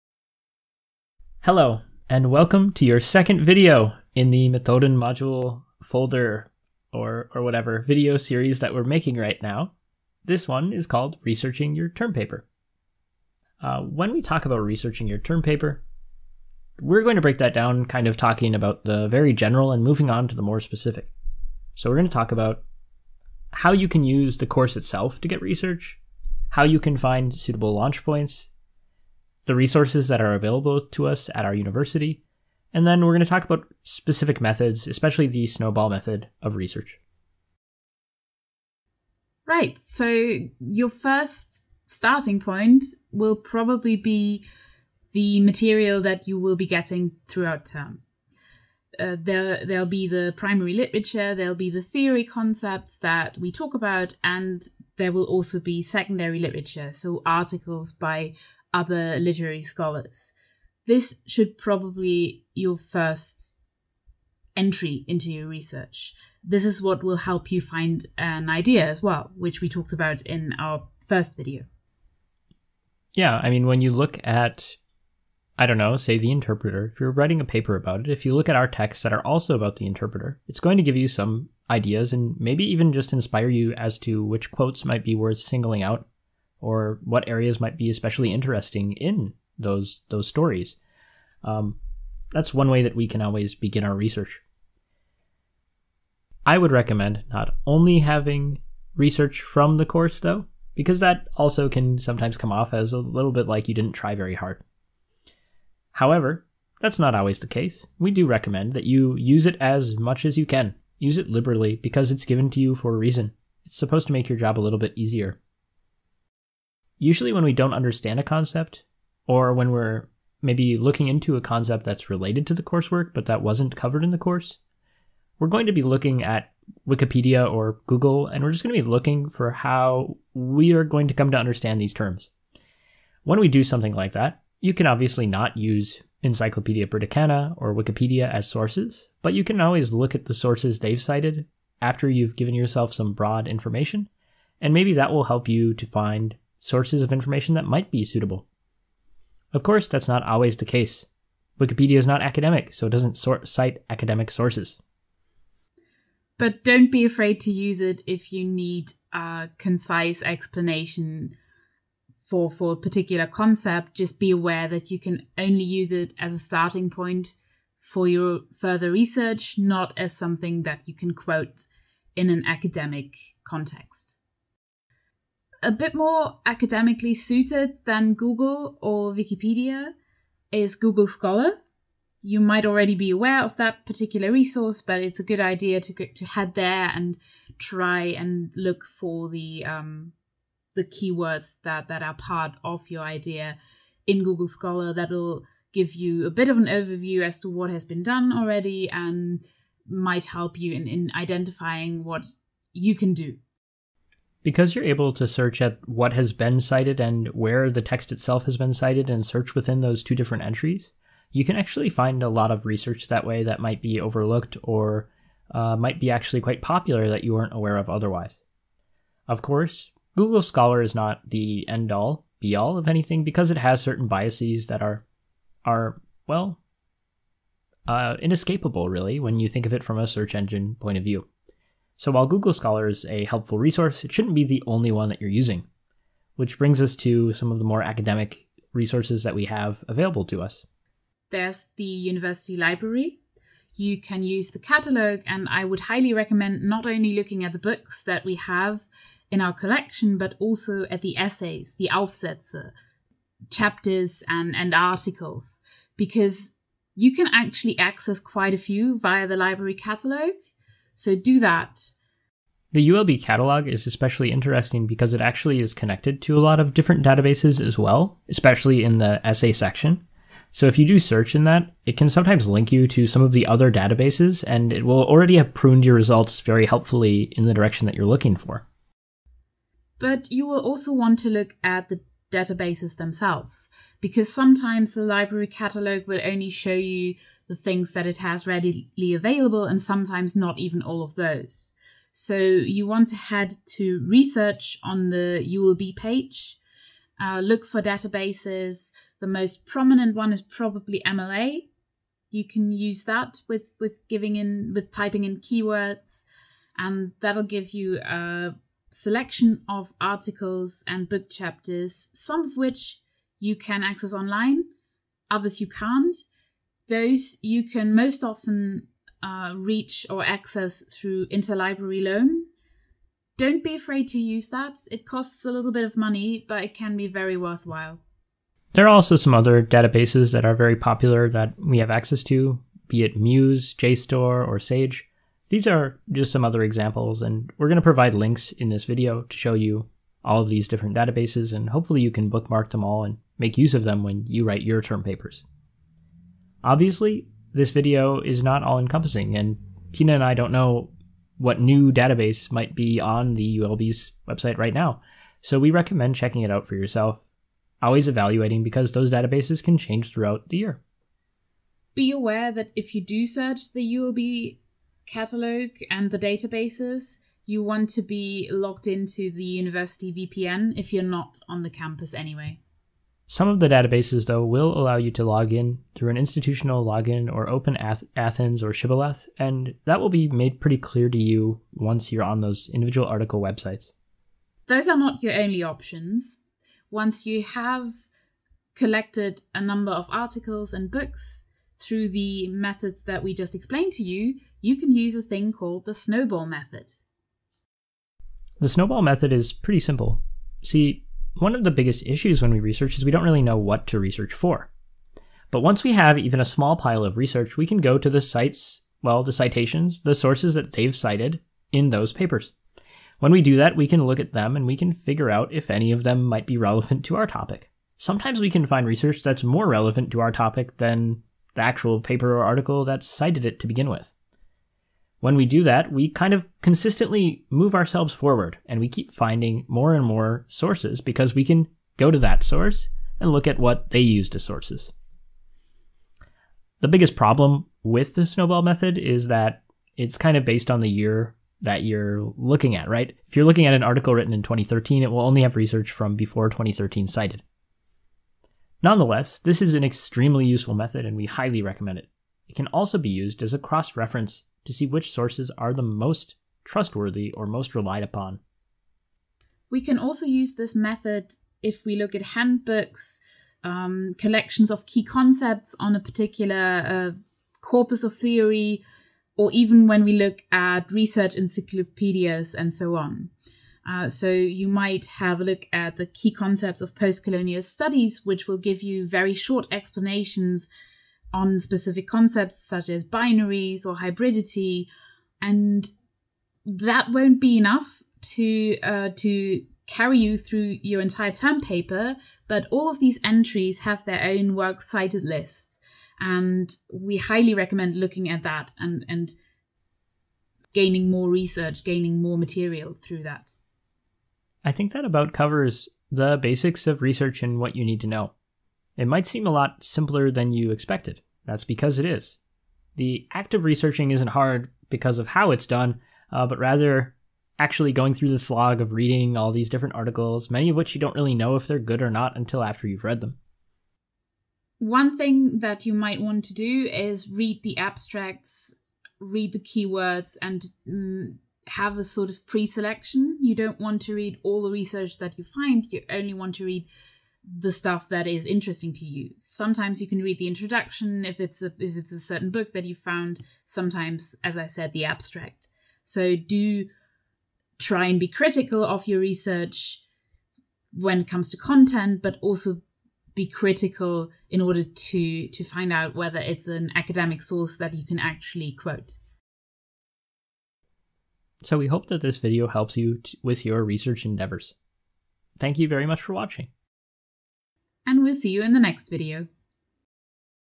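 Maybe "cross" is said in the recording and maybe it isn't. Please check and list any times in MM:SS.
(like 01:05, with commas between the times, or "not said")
07:33.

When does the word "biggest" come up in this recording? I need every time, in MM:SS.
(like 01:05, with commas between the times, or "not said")
06:41, 07:16.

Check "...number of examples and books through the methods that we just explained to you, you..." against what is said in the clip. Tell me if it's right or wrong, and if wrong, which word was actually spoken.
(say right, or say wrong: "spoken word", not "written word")
wrong: "articles", not "examples".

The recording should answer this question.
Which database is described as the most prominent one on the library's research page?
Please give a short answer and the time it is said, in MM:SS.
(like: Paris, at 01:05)
MLA, at 05:01.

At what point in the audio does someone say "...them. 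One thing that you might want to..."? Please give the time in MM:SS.
08:43.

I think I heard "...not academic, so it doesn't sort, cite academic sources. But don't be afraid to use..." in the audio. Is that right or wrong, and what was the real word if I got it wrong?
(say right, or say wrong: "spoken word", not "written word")
right.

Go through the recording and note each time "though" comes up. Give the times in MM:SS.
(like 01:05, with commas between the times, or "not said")
01:40, 06:14.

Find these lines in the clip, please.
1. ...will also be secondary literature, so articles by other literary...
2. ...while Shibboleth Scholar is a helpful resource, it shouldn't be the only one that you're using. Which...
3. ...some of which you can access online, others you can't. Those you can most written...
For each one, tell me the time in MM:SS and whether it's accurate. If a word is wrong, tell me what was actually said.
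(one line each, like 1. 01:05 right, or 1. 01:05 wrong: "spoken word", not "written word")
1. 00:55 right
2. 03:52 wrong: "Google", not "Shibboleth"
3. 05:12 wrong: "often", not "written".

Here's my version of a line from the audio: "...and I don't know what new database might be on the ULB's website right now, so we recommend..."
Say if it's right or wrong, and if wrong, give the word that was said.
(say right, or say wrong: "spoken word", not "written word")
right.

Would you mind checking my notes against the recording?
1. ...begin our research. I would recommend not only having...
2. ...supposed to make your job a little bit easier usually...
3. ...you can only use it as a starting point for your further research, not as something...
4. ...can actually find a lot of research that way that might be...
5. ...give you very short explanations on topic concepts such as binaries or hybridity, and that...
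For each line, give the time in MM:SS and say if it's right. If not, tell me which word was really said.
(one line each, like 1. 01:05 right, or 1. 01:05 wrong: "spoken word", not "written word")
1. 01:33 right
2. 01:53 right
3. 02:44 right
4. 03:31 right
5. 07:58 wrong: "specific", not "topic".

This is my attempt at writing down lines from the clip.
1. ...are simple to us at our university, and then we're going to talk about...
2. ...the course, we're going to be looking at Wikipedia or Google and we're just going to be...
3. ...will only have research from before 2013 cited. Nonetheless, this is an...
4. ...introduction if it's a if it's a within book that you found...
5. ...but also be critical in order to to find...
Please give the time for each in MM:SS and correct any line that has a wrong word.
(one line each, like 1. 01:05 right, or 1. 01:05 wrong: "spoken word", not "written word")
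1. 00:30 wrong: "available", not "simple"
2. 02:04 right
3. 07:25 right
4. 09:00 wrong: "certain", not "within"
5. 09:12 right.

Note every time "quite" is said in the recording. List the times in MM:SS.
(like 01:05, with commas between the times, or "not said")
03:36, 04:18.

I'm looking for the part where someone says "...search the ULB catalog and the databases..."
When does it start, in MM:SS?
06:03.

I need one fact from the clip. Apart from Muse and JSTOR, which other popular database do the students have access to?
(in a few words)
Sage.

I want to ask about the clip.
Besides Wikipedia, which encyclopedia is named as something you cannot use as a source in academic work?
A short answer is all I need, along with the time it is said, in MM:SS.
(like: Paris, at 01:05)
Encyclopedia Britannica, at 02:16.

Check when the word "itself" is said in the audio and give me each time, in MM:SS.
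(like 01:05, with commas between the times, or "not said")
00:24, 03:28.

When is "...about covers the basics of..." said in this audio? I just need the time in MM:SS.
08:25.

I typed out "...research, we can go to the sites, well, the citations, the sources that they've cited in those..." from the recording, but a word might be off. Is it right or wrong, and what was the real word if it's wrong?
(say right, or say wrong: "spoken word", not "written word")
right.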